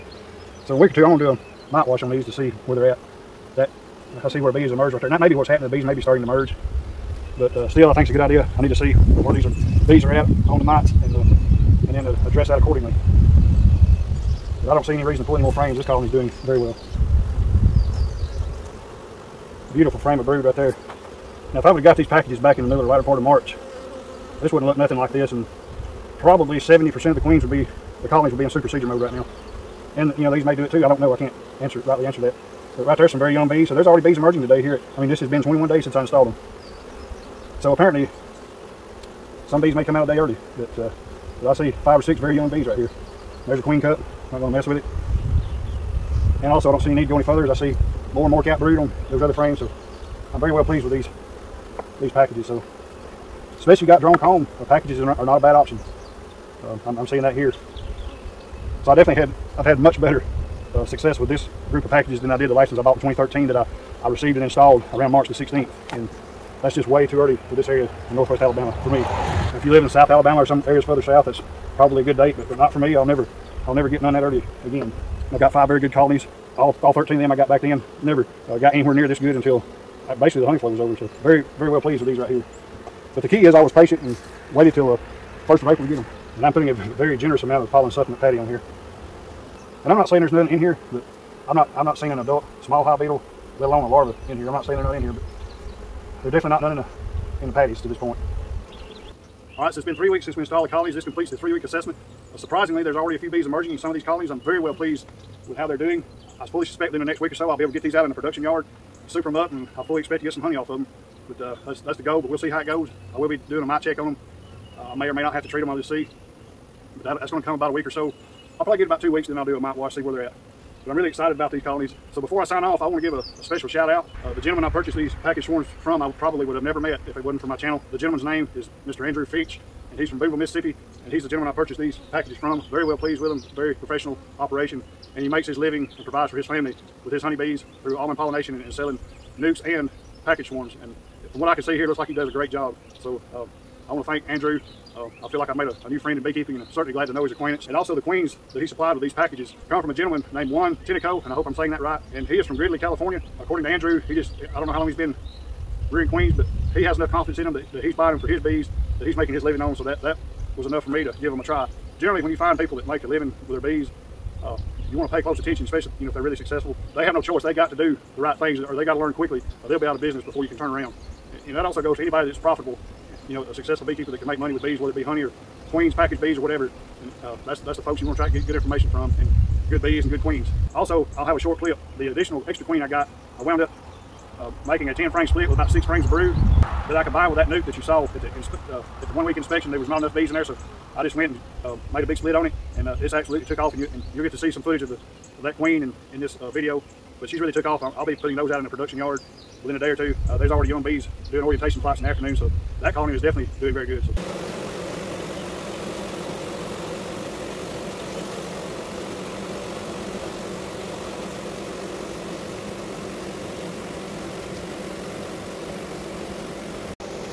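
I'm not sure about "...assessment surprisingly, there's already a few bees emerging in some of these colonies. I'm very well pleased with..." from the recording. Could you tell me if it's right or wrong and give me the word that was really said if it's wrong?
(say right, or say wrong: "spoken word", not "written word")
right.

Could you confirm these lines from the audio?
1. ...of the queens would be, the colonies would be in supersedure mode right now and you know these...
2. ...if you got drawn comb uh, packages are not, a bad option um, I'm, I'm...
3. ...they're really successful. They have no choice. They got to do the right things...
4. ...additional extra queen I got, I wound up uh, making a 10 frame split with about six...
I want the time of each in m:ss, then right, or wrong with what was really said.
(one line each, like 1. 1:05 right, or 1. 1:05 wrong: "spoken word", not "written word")
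1. 0:27 right
2. 0:53 right
3. 2:46 right
4. 3:02 right.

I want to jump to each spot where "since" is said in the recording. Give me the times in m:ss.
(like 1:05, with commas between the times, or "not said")
0:35, 1:40.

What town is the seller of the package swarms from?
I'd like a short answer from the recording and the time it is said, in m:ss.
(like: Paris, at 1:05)
Booneville, Mississippi, at 2:10.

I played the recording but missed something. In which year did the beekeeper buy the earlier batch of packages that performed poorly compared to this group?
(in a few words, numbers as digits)
2013.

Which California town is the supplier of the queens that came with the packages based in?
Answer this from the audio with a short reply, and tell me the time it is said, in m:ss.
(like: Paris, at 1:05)
Gridley, at 2:32.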